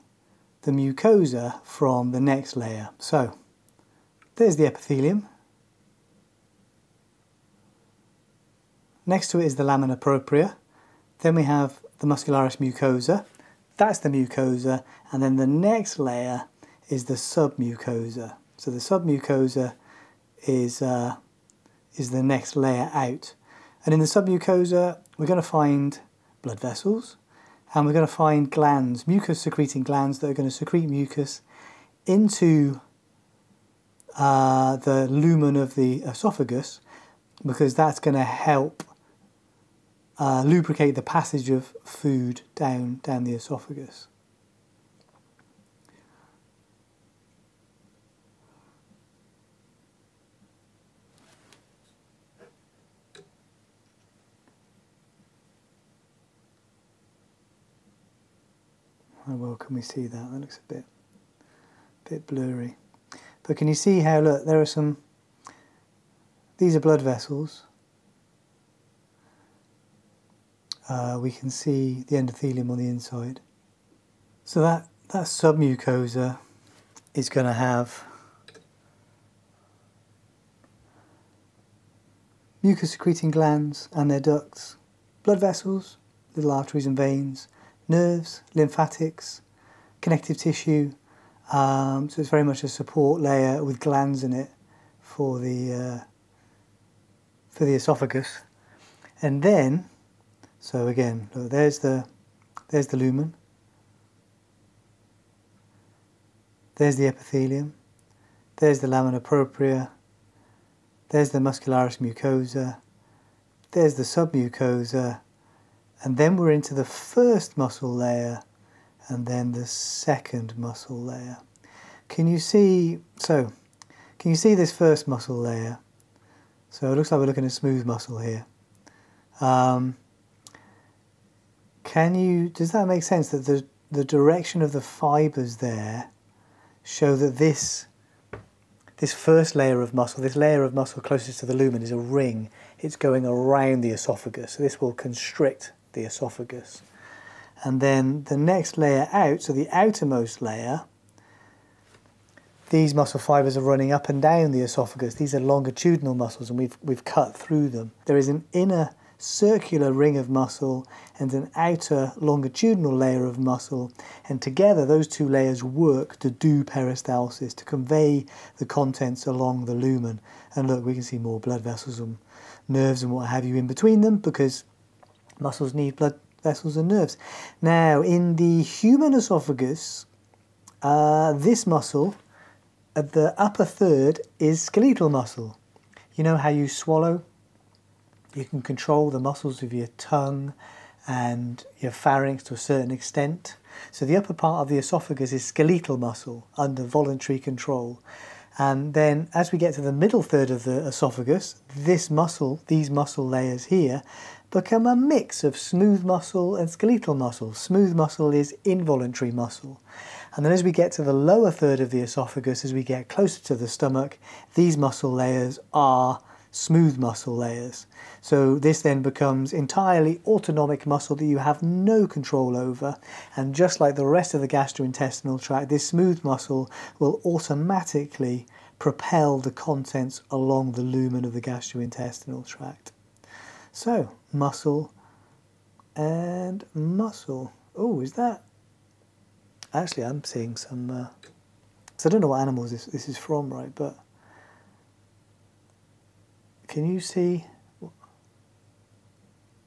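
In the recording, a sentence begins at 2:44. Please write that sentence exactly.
And together, those two layers work to do peristalsis, to convey the contents along the lumen.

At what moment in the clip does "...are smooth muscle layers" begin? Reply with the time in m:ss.
3:35.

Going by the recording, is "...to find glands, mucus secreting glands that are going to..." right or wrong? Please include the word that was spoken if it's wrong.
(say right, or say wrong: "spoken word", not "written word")
right.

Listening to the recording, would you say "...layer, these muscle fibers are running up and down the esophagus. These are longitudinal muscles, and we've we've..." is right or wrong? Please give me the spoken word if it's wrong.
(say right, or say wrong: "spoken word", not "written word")
right.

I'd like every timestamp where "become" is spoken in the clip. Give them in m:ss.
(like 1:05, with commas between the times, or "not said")
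3:24, 3:39.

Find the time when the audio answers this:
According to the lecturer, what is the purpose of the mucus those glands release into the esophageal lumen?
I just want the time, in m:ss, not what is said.
0:40.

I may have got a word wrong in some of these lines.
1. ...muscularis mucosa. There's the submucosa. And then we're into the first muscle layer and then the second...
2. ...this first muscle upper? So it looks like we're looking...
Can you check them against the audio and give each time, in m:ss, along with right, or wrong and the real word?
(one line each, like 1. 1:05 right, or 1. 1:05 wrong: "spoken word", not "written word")
1. 1:51 right
2. 2:04 wrong: "layer", not "upper".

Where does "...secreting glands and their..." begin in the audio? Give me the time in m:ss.
1:22.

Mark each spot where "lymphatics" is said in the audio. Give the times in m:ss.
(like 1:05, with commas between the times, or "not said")
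1:28.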